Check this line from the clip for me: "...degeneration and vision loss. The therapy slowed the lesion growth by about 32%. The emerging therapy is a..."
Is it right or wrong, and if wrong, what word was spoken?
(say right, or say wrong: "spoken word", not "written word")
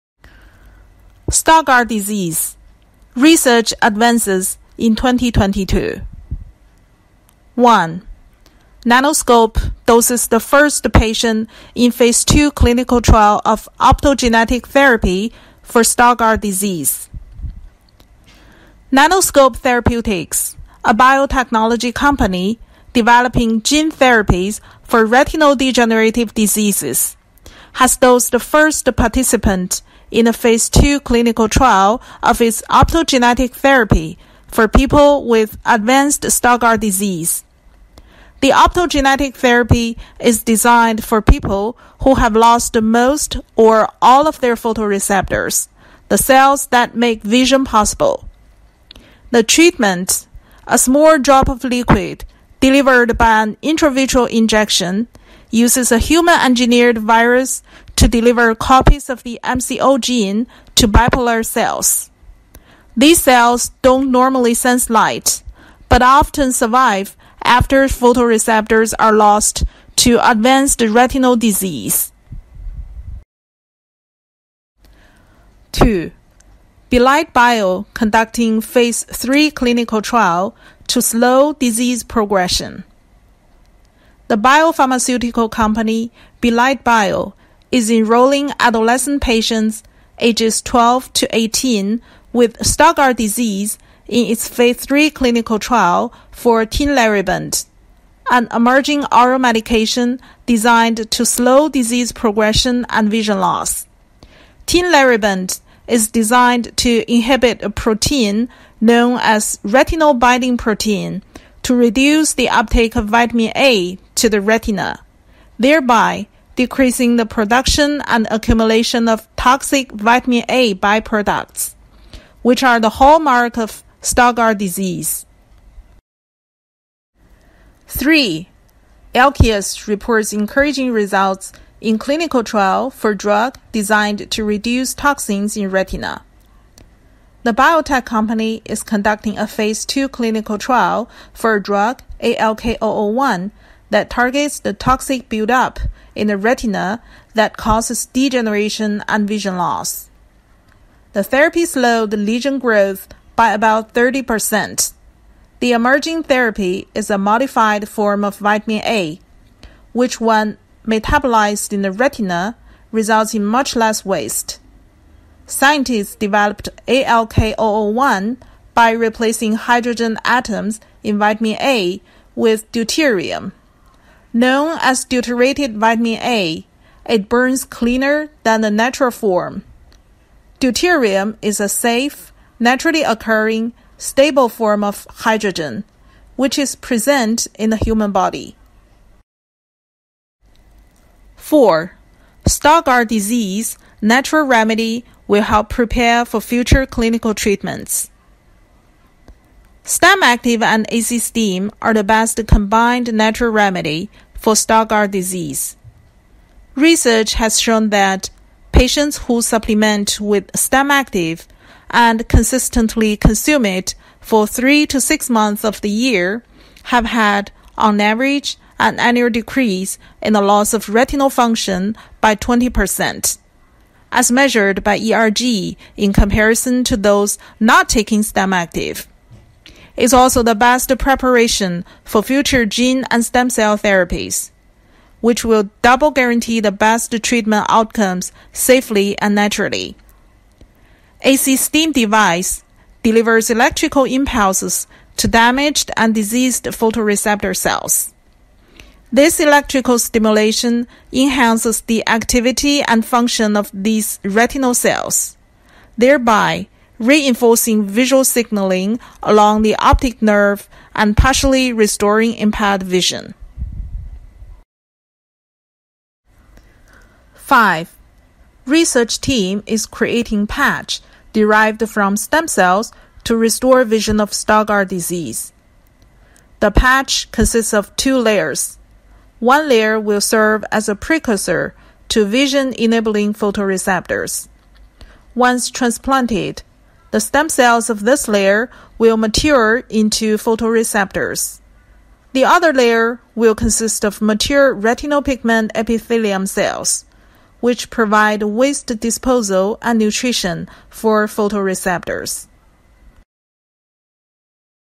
wrong: "30", not "32".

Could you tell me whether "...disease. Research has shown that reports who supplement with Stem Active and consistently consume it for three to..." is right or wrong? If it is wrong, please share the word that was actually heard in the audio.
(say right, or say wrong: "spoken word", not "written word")
wrong: "patients", not "reports".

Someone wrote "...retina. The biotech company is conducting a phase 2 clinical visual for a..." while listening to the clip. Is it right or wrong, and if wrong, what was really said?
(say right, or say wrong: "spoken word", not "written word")
wrong: "trial", not "visual".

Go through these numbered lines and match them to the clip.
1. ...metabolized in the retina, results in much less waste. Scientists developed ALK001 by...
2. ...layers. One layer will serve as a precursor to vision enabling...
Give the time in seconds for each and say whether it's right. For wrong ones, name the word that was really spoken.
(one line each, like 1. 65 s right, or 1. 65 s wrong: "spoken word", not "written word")
1. 160 s right
2. 278 s right.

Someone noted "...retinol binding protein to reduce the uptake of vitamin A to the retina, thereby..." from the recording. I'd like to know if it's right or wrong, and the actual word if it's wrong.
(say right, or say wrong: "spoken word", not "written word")
right.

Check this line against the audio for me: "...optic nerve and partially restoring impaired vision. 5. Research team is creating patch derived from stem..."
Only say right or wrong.
right.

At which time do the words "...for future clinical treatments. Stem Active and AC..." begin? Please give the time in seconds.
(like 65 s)
196 s.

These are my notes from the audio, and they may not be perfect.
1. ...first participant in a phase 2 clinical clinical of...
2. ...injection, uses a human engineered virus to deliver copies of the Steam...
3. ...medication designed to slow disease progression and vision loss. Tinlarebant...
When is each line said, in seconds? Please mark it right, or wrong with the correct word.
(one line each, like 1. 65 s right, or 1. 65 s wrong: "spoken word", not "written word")
1. 28 s wrong: "trial", not "clinical"
2. 54 s wrong: "MCO", not "Steam"
3. 99 s right.